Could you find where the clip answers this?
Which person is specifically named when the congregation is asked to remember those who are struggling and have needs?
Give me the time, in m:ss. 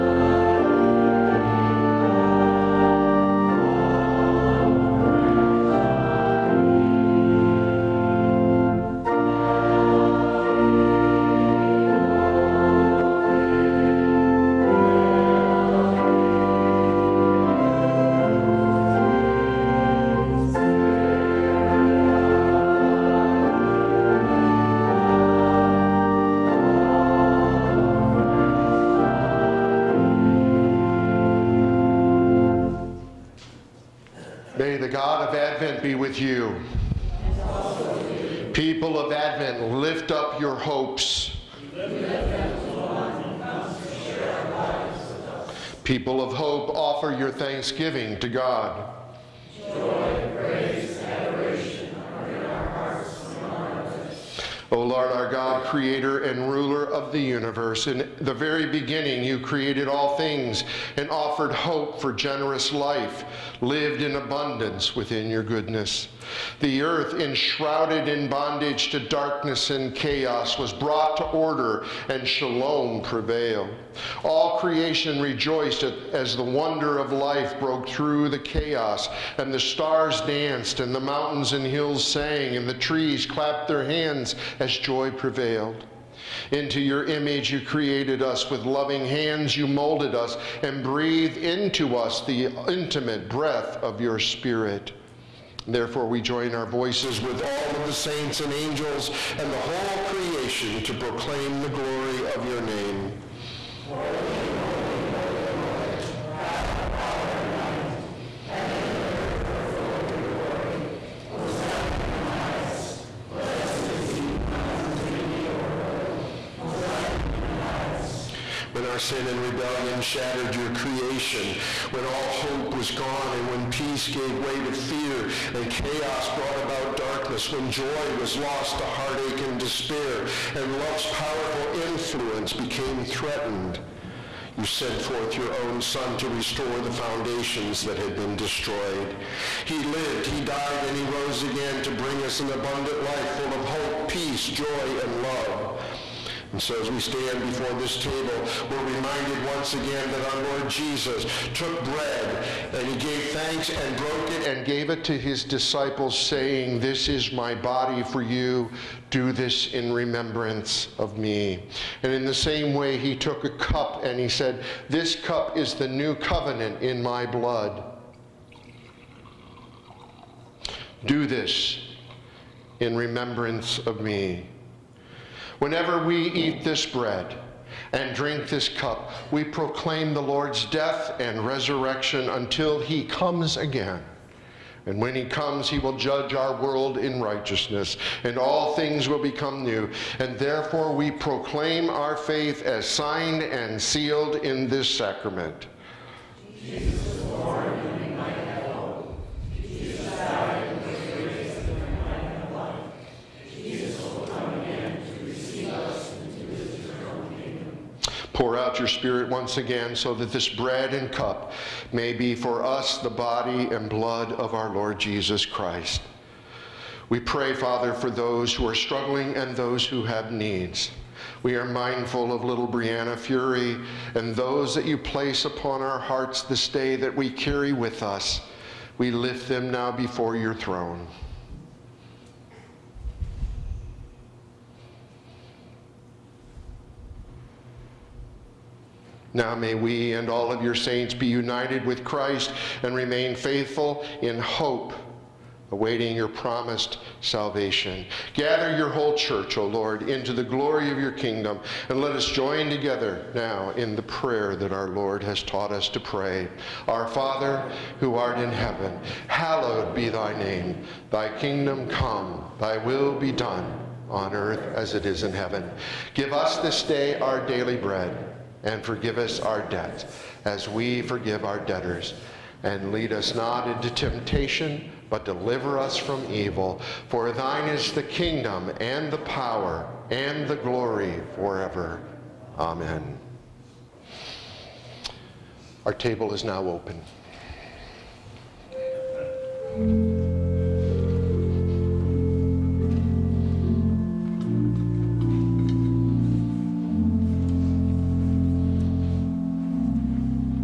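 3:42.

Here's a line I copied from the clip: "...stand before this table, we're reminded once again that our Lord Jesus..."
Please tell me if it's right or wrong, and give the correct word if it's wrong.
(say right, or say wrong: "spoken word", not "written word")
right.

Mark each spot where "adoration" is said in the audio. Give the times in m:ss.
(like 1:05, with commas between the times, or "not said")
0:51.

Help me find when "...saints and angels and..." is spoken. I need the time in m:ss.
1:37.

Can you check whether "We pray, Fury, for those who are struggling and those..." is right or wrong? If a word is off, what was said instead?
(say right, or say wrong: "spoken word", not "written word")
wrong: "Father", not "Fury".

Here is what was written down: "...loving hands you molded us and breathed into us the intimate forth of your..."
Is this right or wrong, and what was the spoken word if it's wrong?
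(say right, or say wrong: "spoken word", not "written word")
wrong: "breath", not "forth".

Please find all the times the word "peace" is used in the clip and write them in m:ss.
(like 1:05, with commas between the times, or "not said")
2:03, 2:24.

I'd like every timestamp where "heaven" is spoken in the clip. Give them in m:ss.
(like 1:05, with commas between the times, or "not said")
4:18, 4:25.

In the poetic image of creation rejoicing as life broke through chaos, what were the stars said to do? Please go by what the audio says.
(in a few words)
danced.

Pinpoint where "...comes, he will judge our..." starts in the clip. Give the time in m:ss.
3:05.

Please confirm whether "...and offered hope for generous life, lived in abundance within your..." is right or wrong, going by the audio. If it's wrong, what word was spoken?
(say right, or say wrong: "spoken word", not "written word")
right.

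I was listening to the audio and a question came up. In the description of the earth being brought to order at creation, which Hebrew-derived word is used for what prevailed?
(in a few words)
shalom.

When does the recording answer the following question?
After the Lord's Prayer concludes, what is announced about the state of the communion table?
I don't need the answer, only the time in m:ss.
4:46.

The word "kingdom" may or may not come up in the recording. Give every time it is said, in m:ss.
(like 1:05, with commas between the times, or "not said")
4:11, 4:21, 4:38.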